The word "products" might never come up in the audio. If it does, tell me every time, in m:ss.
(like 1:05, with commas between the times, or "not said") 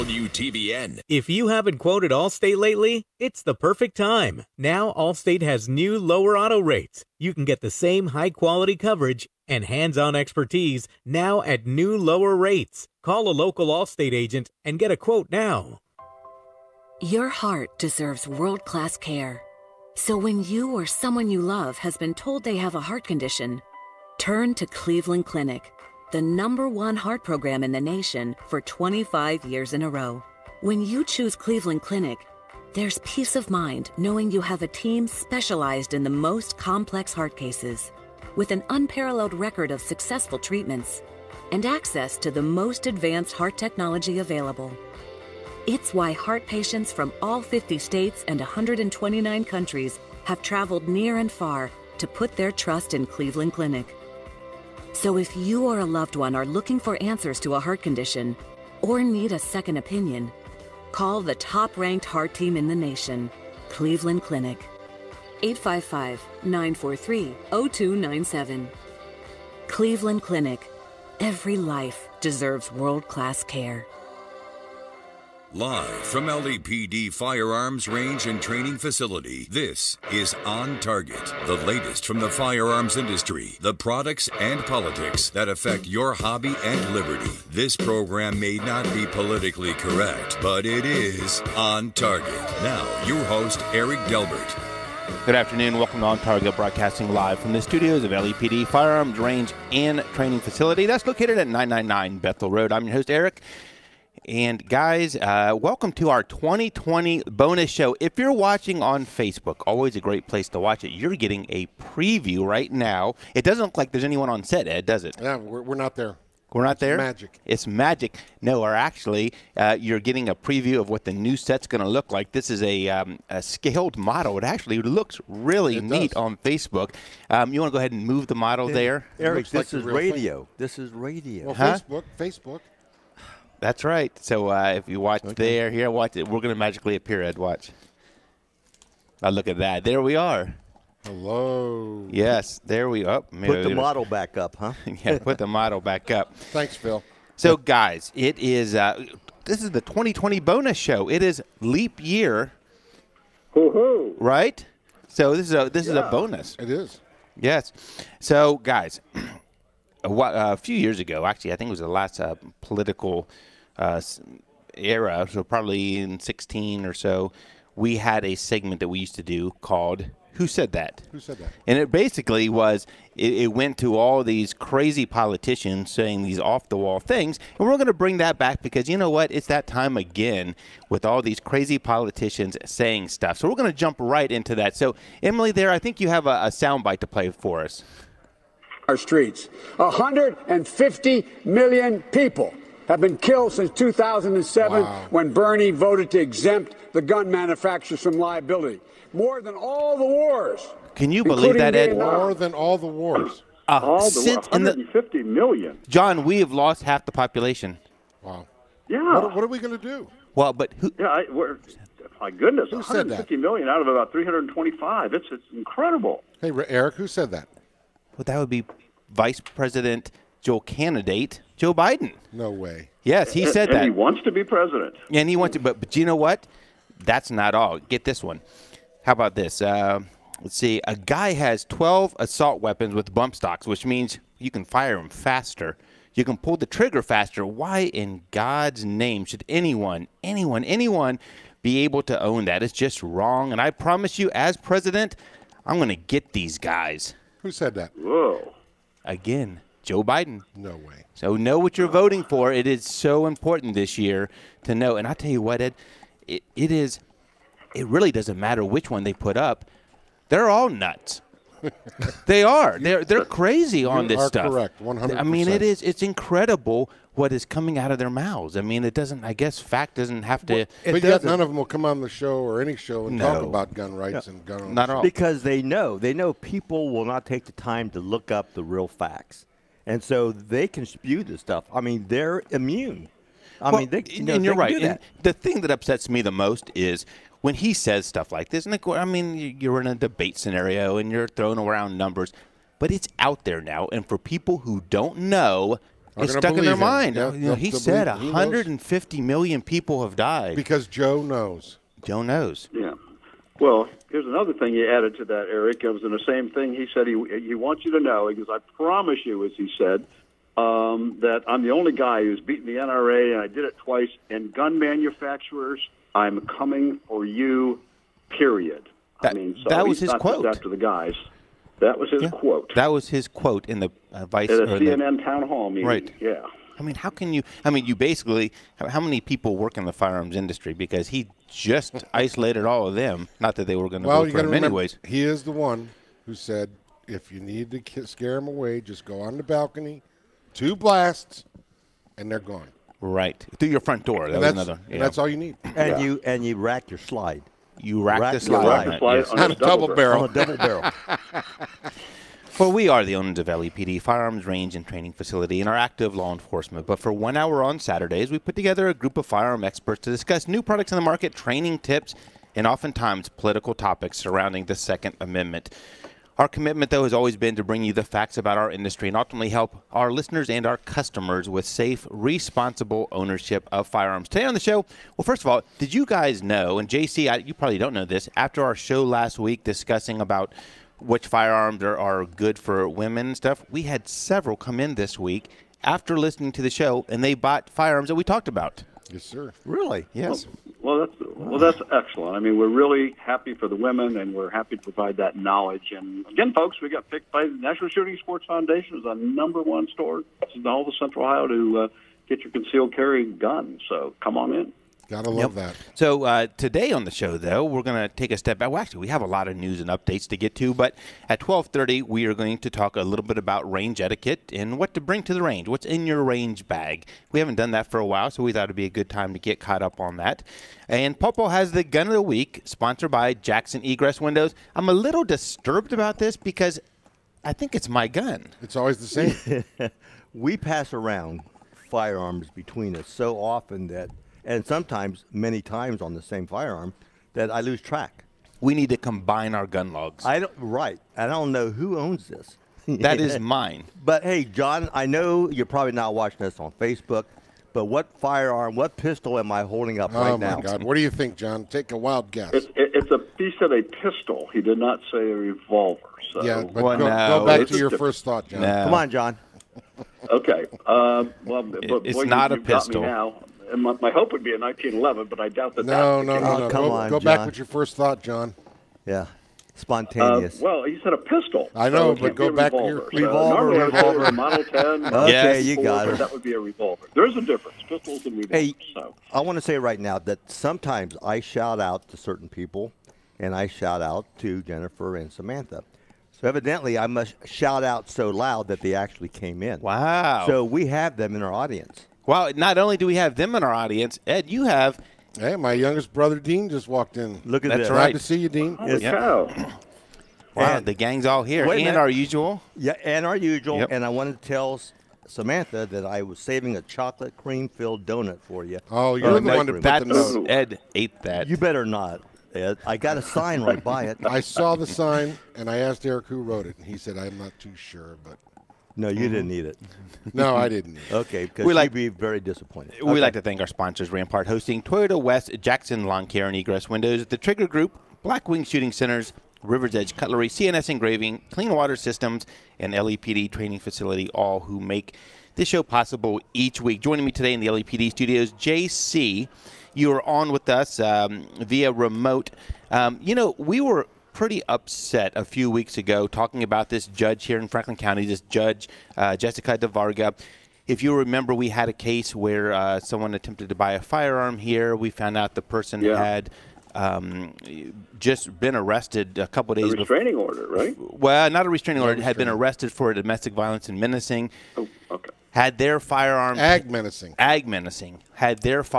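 1:23, 6:00.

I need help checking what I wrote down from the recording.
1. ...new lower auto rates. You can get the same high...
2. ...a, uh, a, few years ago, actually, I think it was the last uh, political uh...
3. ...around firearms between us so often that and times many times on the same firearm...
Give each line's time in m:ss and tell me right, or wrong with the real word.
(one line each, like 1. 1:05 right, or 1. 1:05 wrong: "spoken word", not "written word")
1. 0:05 right
2. 2:40 right
3. 7:10 wrong: "sometimes", not "times".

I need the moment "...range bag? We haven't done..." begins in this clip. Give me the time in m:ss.
6:56.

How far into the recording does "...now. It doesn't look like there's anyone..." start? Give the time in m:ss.
1:52.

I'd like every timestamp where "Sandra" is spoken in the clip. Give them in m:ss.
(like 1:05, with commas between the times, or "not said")
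not said.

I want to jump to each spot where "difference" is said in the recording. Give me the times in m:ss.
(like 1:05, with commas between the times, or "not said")
7:57.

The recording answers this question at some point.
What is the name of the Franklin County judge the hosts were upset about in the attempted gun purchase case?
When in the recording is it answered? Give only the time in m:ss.
9:09.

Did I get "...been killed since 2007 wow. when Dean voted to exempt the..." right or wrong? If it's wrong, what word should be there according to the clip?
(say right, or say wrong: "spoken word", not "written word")
wrong: "Bernie", not "Dean".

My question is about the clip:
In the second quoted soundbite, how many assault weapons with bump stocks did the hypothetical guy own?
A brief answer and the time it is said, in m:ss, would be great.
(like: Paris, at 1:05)
12, at 3:51.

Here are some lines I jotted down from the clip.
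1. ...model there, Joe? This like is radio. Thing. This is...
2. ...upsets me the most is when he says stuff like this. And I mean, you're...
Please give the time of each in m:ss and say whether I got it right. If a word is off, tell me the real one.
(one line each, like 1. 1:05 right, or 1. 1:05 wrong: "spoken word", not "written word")
1. 2:08 wrong: "Eric", not "Joe"
2. 4:45 right.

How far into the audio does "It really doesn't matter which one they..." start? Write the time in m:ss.
4:17.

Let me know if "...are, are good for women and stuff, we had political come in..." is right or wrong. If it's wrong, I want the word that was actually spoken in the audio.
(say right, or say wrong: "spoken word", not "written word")
wrong: "several", not "political".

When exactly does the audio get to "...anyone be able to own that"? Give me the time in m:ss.
4:00.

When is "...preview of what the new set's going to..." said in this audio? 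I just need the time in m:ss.
2:00.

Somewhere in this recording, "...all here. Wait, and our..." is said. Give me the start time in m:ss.
8:21.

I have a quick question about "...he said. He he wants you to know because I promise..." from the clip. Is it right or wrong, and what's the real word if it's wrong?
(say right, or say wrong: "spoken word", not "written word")
right.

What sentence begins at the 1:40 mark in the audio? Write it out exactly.
That's located at 999 Bethel Road.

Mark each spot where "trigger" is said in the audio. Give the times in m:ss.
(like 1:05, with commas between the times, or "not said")
3:56, 8:47.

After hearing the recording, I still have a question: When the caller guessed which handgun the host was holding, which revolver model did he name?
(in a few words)
Model 10.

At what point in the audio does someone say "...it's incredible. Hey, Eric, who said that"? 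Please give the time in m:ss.
3:35.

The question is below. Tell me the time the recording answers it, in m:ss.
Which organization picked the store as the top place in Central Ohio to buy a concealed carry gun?
6:37.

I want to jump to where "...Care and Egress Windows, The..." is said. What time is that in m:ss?
8:46.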